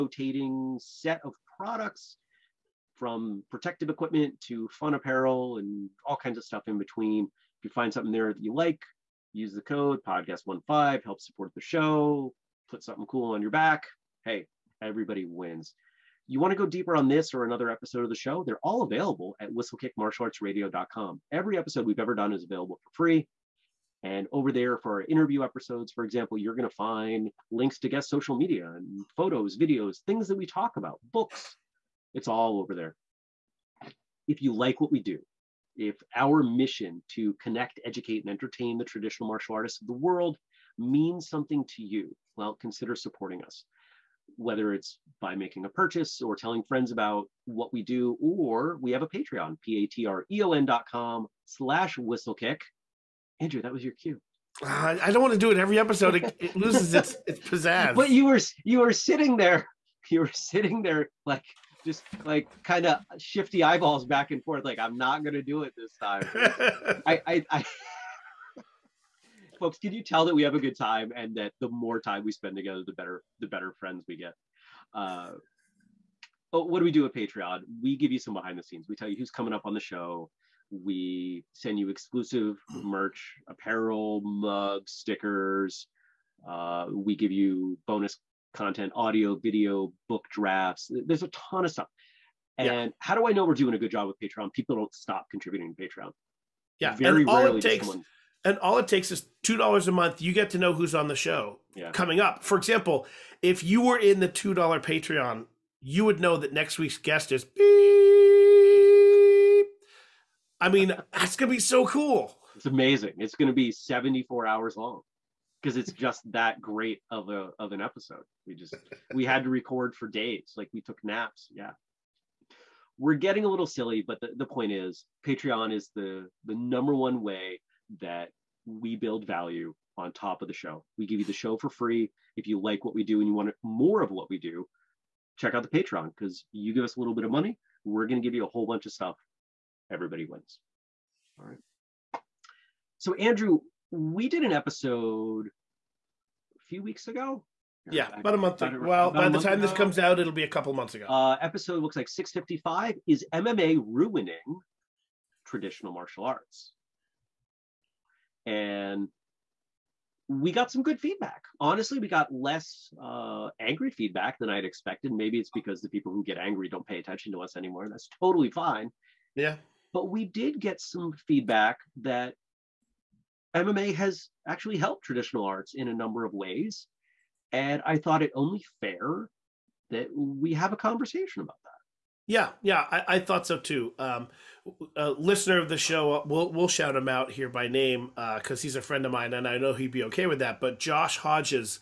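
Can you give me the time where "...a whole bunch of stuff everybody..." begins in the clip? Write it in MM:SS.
02:18.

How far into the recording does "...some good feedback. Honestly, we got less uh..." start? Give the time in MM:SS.
02:40.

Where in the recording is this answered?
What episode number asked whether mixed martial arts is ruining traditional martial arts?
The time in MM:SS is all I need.
02:32.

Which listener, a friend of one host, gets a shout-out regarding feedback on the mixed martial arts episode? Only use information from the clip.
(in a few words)
Josh Hodges.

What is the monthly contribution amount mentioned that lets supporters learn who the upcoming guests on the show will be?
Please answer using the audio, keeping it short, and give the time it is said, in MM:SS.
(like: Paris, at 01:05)
$2, at 01:39.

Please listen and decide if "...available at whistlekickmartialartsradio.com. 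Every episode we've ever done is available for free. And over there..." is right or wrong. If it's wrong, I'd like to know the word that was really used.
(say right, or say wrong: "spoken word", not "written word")
right.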